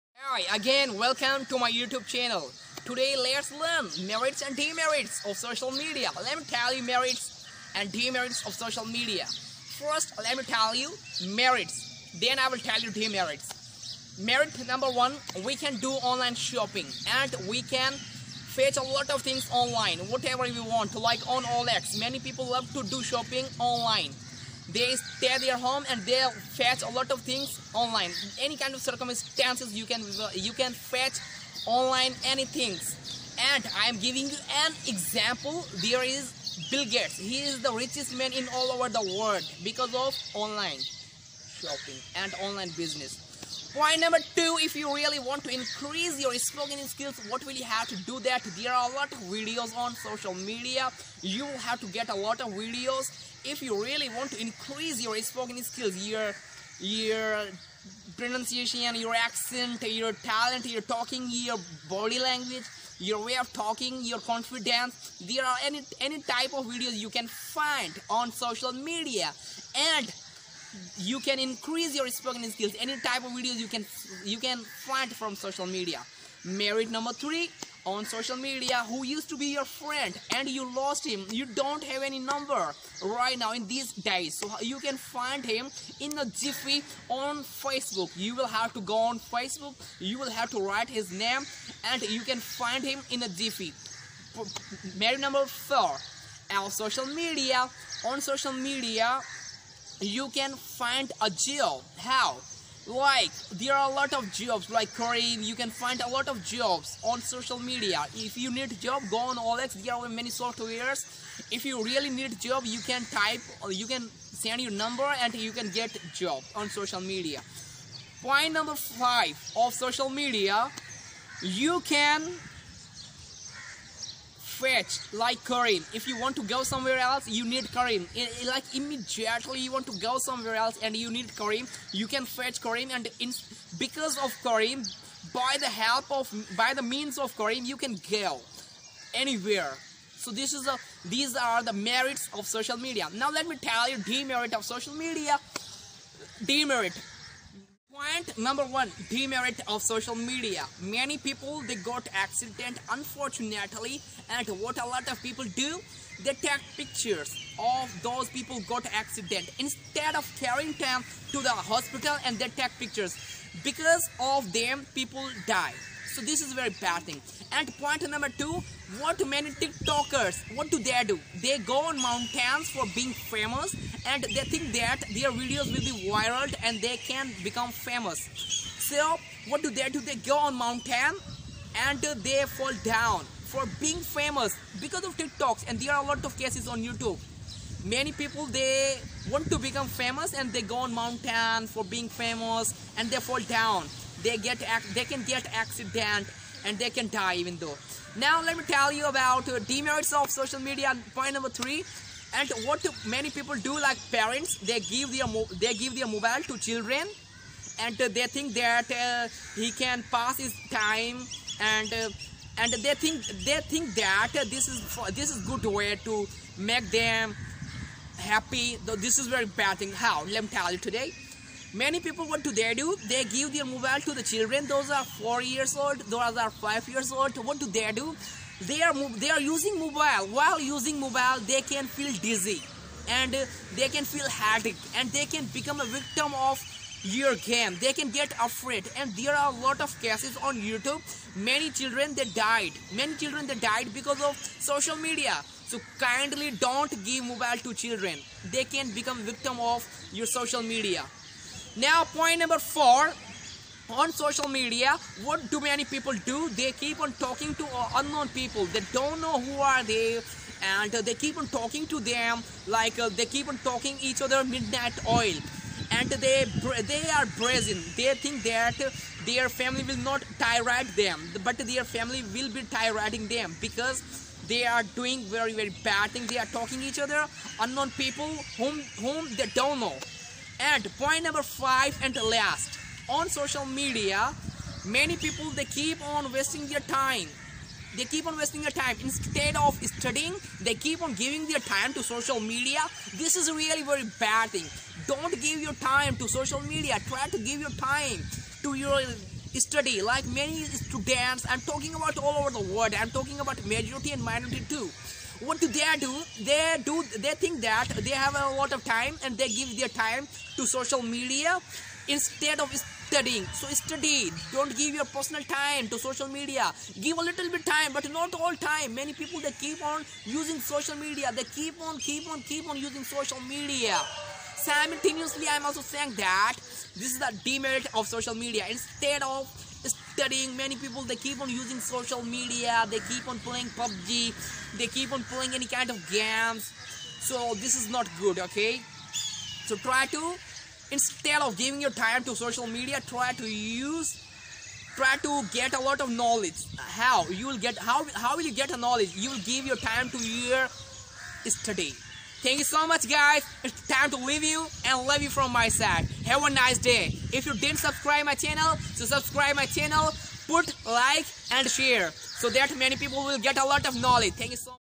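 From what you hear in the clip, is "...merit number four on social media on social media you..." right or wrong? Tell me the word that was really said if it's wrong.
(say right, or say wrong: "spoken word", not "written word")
right.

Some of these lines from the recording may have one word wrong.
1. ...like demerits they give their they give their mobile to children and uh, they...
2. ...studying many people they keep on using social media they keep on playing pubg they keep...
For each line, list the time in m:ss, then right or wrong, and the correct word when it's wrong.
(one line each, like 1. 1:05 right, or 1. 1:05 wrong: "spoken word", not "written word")
1. 3:23 wrong: "parents", not "demerits"
2. 5:30 right.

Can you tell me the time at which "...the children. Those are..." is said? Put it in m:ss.
3:44.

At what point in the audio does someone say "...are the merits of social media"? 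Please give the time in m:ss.
2:21.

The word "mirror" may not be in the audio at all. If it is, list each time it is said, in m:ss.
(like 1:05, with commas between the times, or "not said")
not said.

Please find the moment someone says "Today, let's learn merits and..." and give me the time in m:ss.
0:02.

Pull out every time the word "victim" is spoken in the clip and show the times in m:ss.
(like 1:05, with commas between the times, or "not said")
3:55, 4:09.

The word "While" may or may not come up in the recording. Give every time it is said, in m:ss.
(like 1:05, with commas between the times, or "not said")
3:50.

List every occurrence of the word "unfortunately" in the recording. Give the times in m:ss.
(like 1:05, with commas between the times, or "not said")
2:32.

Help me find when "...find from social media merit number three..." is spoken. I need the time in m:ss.
1:14.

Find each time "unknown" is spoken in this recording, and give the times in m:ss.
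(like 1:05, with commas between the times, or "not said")
4:17, 4:37.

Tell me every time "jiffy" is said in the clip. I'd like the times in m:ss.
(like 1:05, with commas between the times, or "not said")
1:26, 1:33.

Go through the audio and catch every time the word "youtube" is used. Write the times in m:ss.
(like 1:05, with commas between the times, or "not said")
0:01, 3:06, 4:00.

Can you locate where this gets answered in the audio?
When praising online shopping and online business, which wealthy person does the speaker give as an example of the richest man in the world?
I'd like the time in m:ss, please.
0:36.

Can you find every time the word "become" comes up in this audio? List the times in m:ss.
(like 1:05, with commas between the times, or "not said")
2:57, 3:09, 3:55, 4:08.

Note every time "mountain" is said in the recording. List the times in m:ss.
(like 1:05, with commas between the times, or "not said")
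2:52, 3:00, 3:10.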